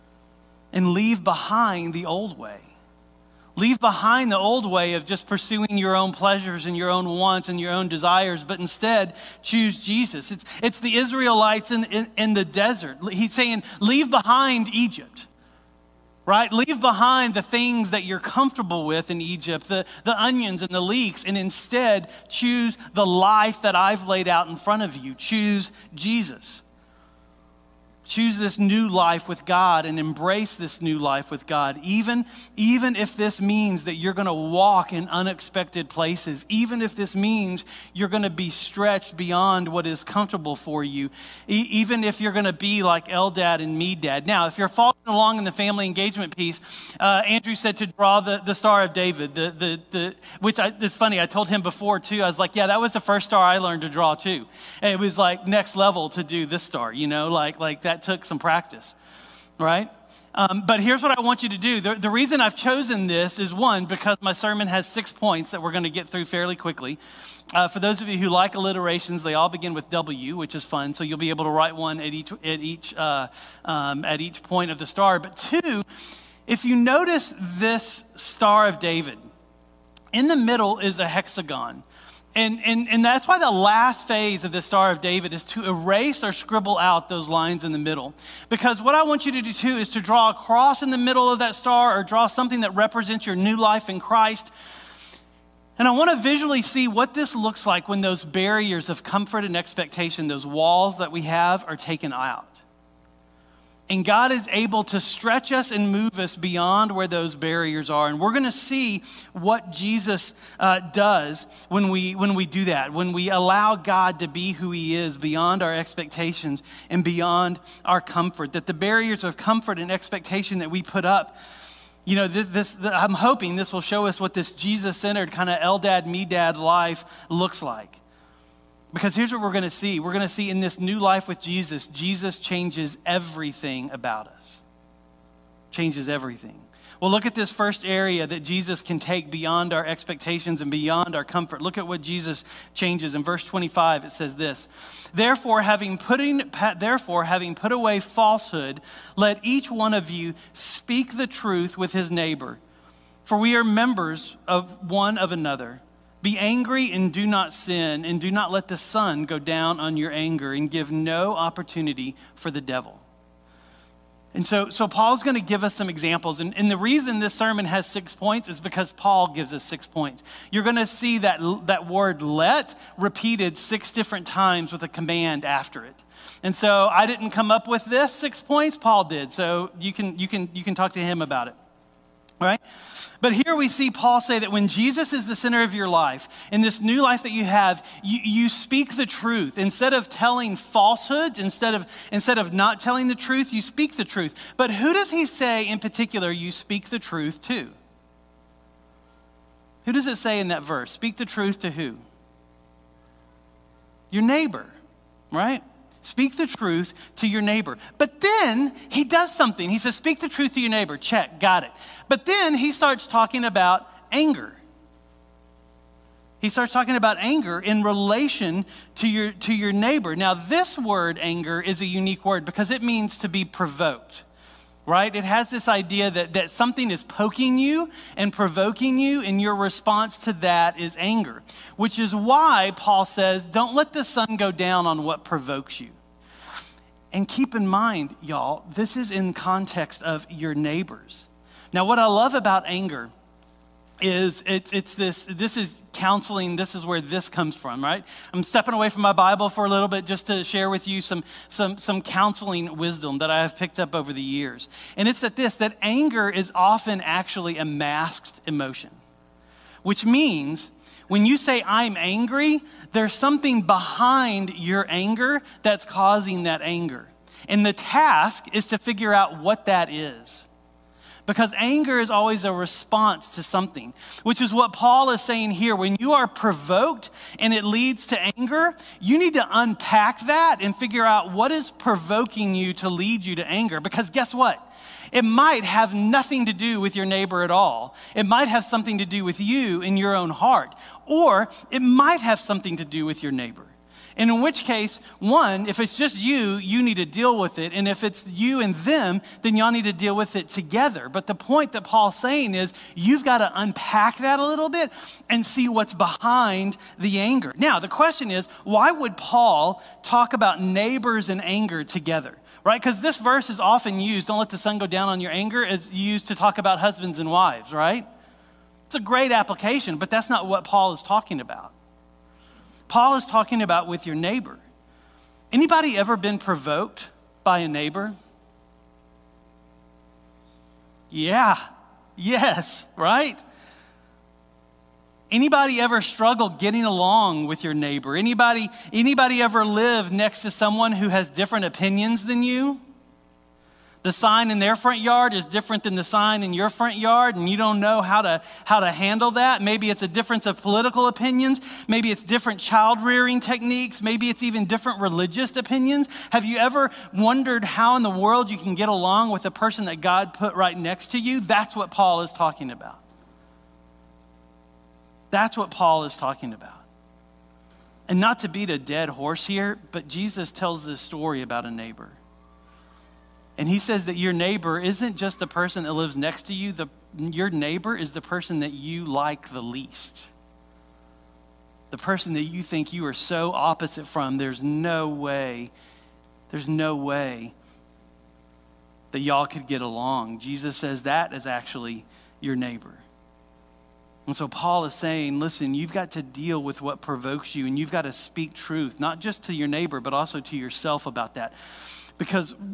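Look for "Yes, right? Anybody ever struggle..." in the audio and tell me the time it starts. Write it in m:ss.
5:32.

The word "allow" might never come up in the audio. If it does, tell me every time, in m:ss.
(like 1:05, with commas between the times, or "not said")
1:53.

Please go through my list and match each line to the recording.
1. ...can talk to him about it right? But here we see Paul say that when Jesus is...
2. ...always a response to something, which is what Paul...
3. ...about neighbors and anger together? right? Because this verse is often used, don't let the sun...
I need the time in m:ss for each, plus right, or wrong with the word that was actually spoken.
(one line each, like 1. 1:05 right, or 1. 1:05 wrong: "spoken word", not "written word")
1. 3:00 right
2. 4:32 right
3. 5:10 right.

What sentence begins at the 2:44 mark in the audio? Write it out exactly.
And so, so Paul's going to give us some examples.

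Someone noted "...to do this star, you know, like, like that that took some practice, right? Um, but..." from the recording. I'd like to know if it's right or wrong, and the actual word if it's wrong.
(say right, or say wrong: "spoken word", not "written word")
right.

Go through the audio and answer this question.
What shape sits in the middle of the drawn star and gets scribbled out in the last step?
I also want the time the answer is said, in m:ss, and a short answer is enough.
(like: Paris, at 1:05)
hexagon, at 1:21.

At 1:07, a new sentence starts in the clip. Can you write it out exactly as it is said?
Uh, for those of you who like alliterations, they all begin with W, which is fun.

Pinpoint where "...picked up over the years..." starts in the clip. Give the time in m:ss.
4:13.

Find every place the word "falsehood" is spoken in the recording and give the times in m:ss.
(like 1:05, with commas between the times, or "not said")
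2:27, 3:10.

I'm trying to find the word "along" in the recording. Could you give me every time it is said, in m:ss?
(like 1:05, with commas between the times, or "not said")
0:45, 5:36, 5:58, 6:29.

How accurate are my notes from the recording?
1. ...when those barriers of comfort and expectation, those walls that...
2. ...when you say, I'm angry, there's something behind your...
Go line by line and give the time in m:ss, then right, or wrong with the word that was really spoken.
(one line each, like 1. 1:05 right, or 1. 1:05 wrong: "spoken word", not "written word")
1. 1:37 right
2. 4:21 right.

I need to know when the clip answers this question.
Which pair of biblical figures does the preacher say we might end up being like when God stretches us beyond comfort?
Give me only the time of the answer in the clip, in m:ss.
0:43.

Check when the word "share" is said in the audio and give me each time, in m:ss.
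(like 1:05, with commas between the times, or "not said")
4:10.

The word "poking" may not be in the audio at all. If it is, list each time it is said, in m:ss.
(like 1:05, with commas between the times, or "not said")
3:47.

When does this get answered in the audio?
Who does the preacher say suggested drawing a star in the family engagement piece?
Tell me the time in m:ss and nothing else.
0:47.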